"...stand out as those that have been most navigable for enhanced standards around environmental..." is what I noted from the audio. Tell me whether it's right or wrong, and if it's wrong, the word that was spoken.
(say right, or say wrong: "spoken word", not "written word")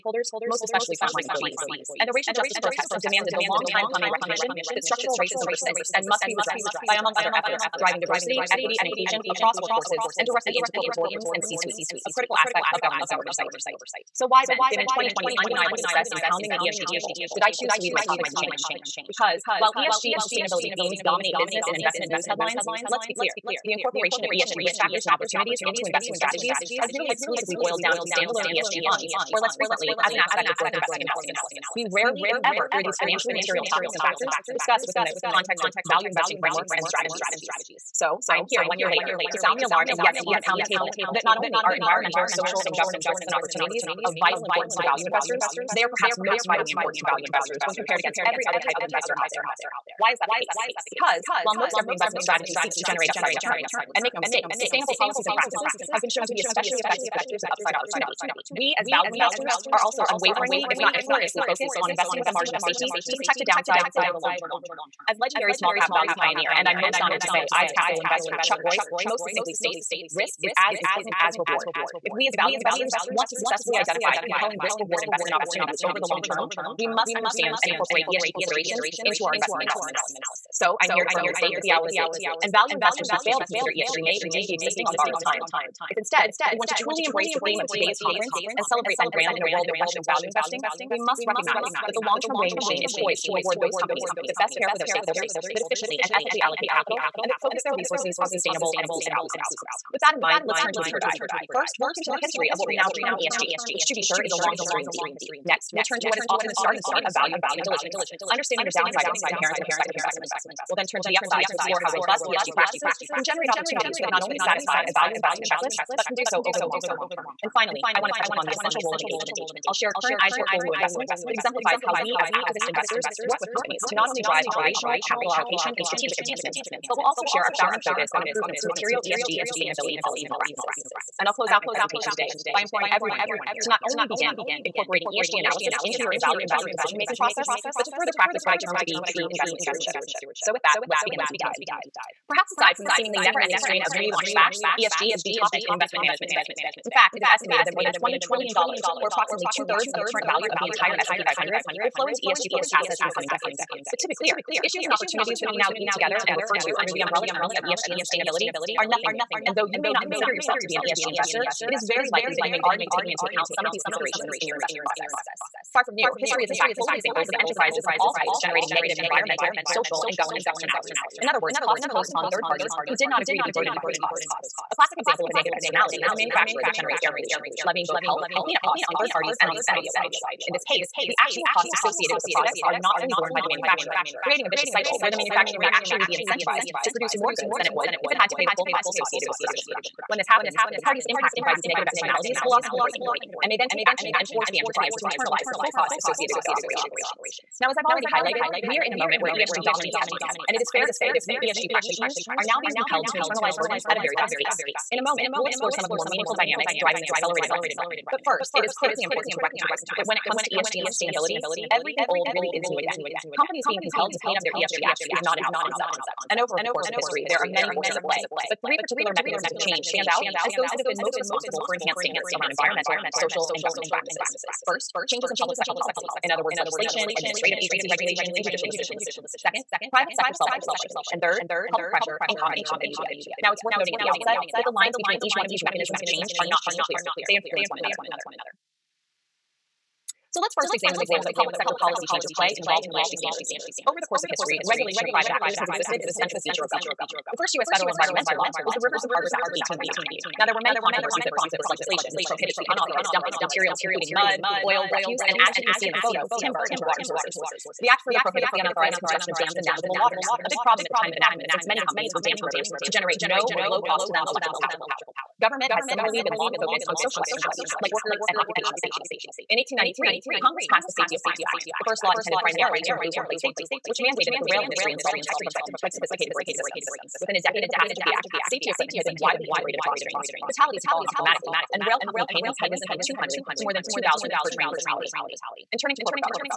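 wrong: "responsible", not "navigable".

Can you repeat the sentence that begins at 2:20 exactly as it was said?
So, with that, let's begin the deep dive.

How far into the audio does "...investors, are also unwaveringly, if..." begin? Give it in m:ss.
0:59.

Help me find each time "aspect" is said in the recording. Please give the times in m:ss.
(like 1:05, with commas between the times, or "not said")
0:12, 0:30.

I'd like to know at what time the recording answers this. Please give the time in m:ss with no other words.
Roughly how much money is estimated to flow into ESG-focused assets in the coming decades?
2:27.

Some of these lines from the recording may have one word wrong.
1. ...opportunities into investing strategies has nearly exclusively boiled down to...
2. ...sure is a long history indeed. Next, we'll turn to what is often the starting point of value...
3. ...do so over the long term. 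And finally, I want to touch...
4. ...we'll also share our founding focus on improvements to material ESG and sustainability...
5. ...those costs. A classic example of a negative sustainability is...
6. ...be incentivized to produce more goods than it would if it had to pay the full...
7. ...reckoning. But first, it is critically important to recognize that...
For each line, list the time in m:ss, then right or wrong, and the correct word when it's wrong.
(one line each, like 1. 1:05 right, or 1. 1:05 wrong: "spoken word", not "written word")
1. 0:25 right
2. 1:44 right
3. 1:56 right
4. 2:06 right
5. 2:53 wrong: "externality", not "sustainability"
6. 3:06 right
7. 3:27 right.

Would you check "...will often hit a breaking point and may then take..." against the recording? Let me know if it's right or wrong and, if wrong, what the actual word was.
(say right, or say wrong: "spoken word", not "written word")
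right.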